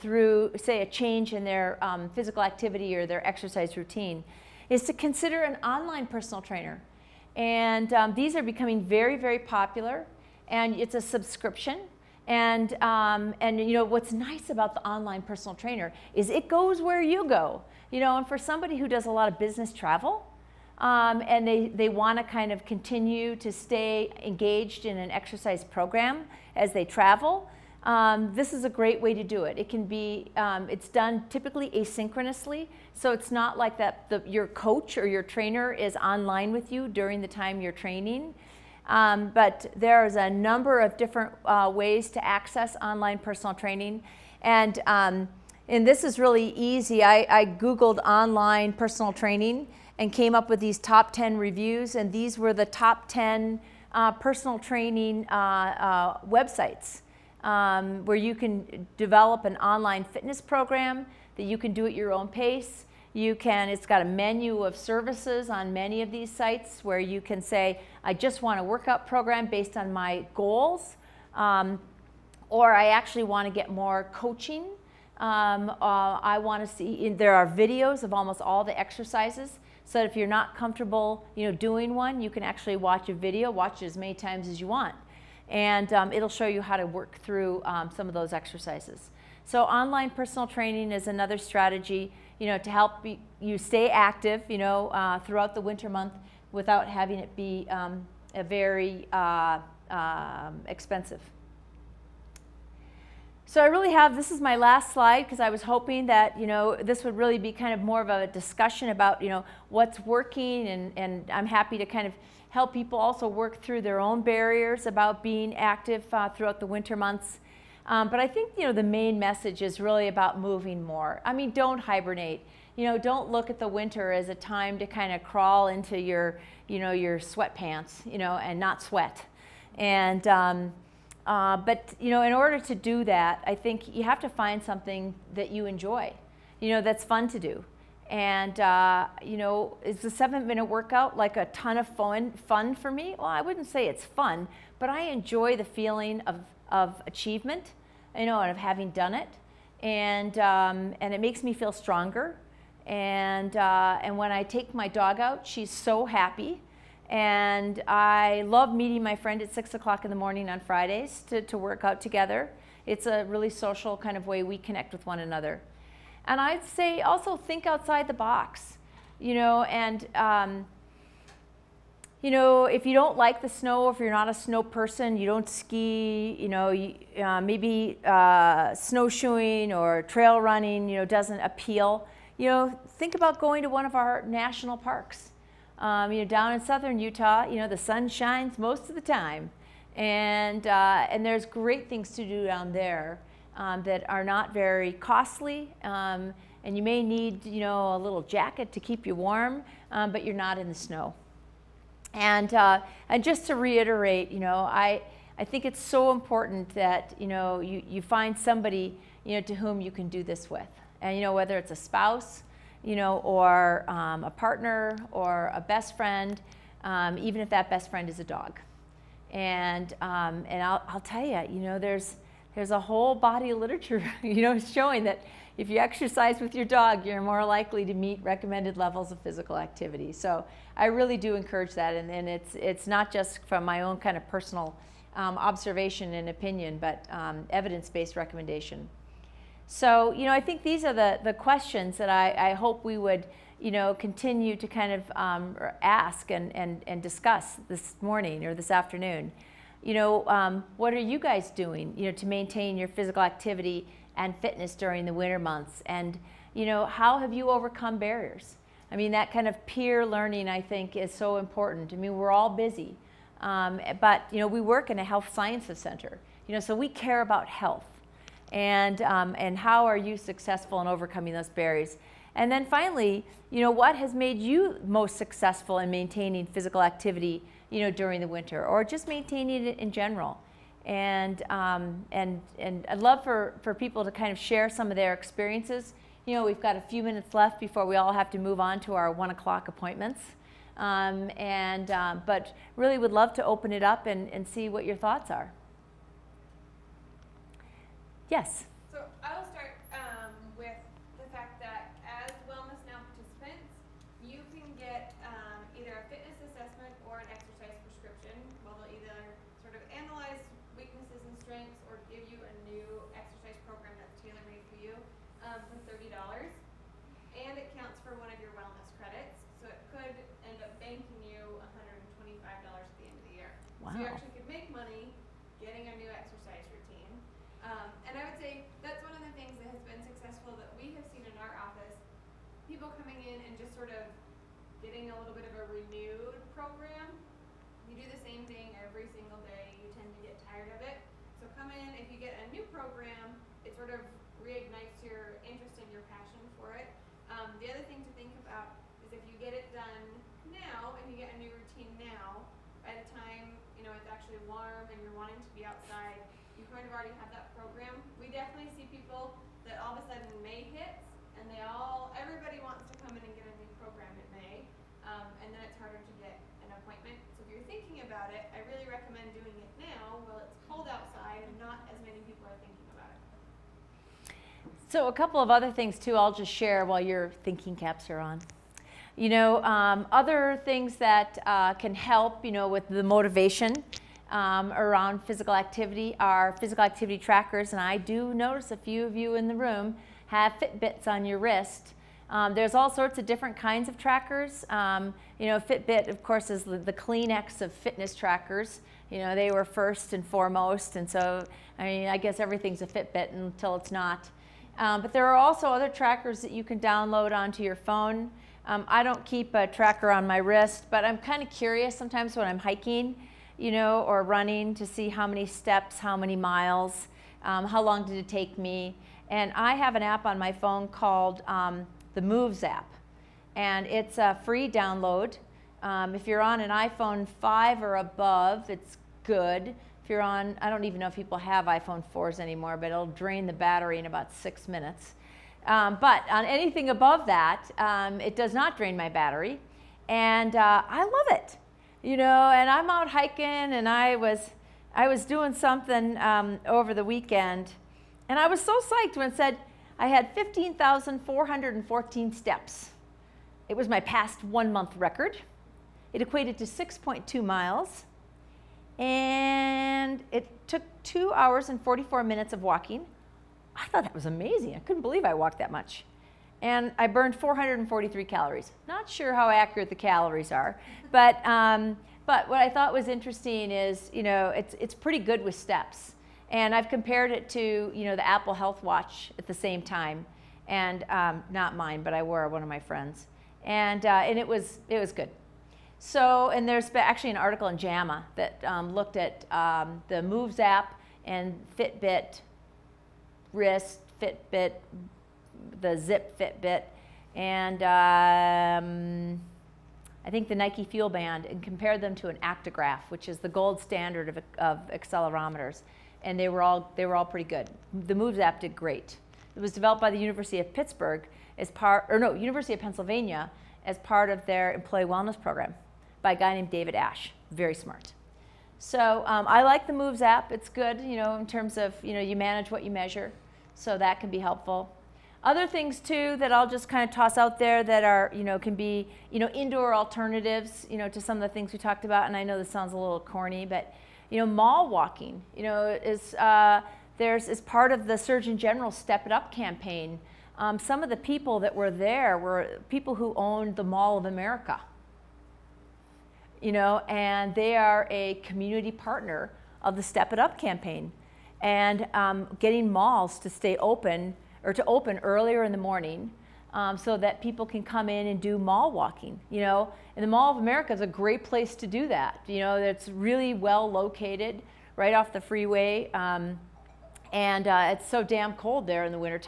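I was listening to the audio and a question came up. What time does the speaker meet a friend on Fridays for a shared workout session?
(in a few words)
6 o'clock.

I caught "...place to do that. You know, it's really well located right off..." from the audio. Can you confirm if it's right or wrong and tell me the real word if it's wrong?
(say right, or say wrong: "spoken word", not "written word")
right.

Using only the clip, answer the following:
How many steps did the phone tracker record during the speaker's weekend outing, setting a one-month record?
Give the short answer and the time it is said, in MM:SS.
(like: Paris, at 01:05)
15,414, at 07:30.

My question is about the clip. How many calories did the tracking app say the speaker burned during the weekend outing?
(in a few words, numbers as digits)
443.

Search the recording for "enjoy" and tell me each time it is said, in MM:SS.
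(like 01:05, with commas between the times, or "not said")
02:15, 02:25.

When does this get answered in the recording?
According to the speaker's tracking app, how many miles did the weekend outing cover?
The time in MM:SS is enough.
07:36.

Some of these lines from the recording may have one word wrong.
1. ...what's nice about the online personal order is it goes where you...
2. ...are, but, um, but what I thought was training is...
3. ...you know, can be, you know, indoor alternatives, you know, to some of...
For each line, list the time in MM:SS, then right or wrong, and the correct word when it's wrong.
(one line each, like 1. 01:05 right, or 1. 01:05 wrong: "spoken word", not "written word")
1. 00:13 wrong: "trainer", not "order"
2. 07:50 wrong: "interesting", not "training"
3. 08:48 right.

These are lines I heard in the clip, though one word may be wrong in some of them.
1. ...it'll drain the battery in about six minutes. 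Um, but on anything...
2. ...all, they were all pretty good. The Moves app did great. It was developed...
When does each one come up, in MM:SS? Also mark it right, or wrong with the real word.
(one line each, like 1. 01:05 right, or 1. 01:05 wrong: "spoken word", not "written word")
1. 07:12 right
2. 08:26 right.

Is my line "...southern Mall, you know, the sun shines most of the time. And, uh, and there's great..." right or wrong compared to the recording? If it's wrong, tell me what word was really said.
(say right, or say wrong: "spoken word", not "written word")
wrong: "Utah", not "Mall".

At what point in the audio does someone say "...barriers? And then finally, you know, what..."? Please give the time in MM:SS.
04:31.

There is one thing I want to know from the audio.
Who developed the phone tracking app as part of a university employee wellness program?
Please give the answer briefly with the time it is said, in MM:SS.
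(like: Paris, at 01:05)
David Asch, at 08:36.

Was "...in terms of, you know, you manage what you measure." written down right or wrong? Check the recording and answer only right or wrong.
right.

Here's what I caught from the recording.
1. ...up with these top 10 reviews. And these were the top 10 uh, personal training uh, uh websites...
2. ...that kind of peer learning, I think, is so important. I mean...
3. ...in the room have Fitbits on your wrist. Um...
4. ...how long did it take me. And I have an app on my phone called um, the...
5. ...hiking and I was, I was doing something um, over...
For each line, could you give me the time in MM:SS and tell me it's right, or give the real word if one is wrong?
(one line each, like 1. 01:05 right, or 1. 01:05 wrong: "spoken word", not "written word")
1. 00:50 right
2. 04:19 right
3. 06:29 right
4. 06:57 right
5. 07:23 right.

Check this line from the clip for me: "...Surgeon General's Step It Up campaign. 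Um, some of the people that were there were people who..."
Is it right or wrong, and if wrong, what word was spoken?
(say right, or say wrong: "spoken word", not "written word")
right.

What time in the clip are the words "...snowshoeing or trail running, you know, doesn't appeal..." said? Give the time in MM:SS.
02:58.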